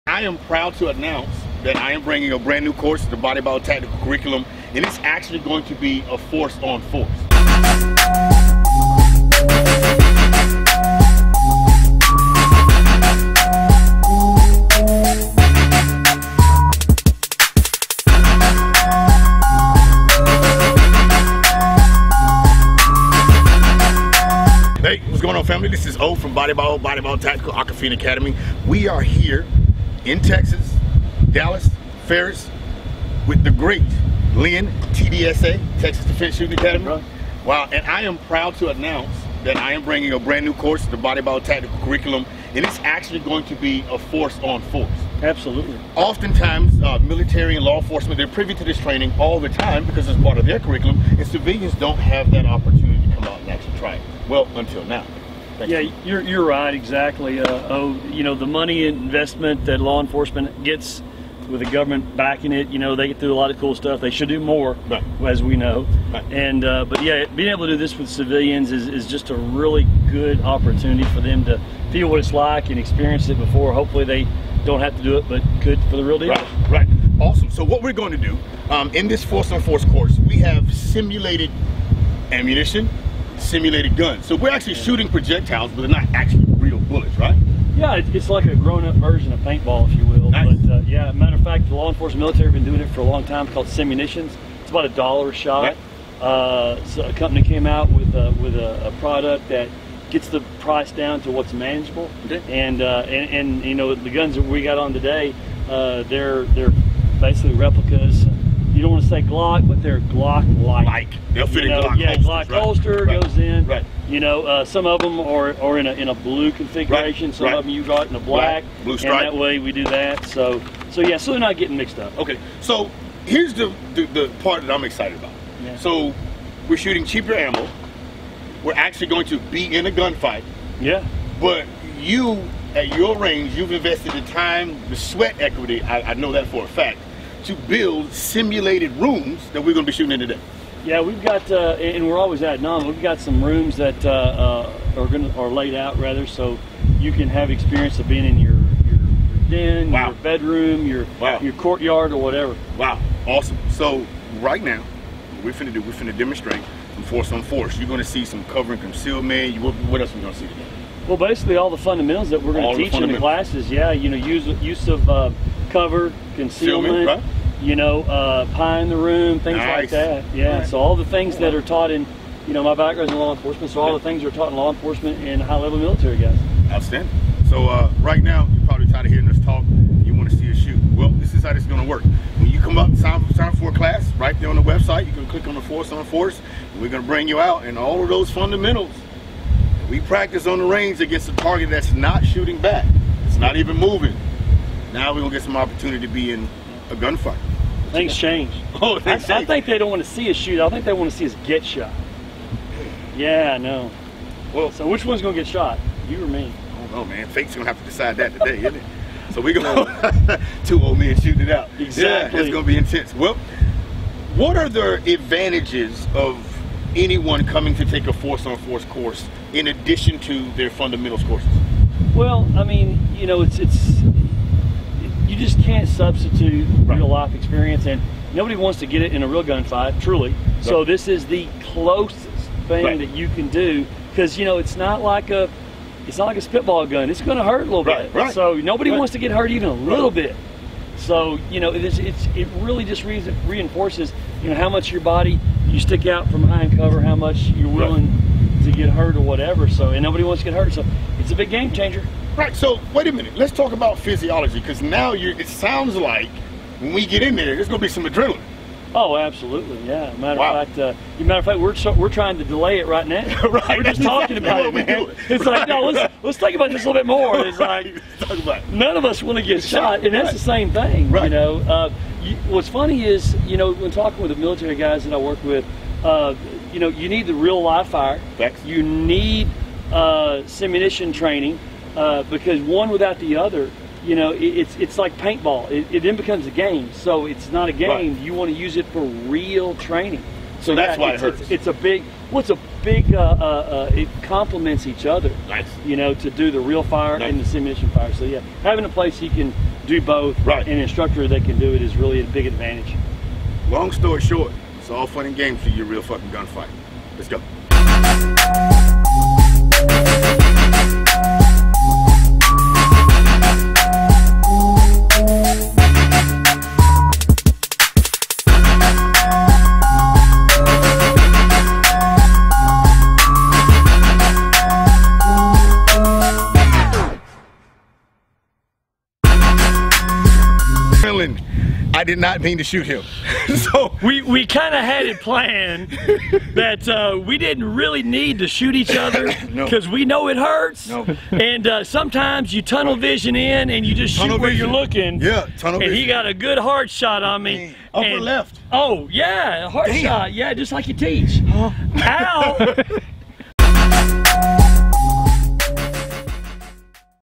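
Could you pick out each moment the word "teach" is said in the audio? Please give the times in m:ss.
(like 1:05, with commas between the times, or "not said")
2:42, 5:50.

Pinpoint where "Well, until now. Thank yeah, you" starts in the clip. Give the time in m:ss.
0:54.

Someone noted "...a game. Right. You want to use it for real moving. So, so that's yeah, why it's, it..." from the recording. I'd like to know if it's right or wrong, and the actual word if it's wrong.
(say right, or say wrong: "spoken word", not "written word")
wrong: "training", not "moving".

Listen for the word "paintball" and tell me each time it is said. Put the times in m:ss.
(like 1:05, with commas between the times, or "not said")
1:29, 4:45.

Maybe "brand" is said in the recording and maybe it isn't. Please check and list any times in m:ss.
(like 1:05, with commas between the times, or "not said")
0:02, 0:40.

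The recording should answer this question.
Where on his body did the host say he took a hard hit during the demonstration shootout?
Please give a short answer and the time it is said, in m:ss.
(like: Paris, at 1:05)
Upper left, at 5:47.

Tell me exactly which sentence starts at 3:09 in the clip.
We practice on the range against a target that's not shooting back.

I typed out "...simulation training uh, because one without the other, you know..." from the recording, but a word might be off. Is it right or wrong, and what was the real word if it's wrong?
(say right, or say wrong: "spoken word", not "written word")
right.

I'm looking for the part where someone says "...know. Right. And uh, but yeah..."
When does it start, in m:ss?
1:05.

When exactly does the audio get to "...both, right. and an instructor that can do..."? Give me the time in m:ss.
5:00.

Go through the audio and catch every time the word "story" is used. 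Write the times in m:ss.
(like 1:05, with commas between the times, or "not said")
5:03.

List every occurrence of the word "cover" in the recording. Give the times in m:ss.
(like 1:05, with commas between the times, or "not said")
2:38, 2:45, 4:06.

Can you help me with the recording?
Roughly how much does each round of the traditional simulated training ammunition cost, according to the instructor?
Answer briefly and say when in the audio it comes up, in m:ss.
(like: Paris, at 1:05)
$1 a shot, at 1:34.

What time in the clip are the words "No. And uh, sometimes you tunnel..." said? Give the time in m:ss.
5:40.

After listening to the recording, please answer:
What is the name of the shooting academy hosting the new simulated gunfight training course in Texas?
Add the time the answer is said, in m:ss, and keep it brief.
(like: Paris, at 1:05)
Texas Defense Shooting Academy, at 0:35.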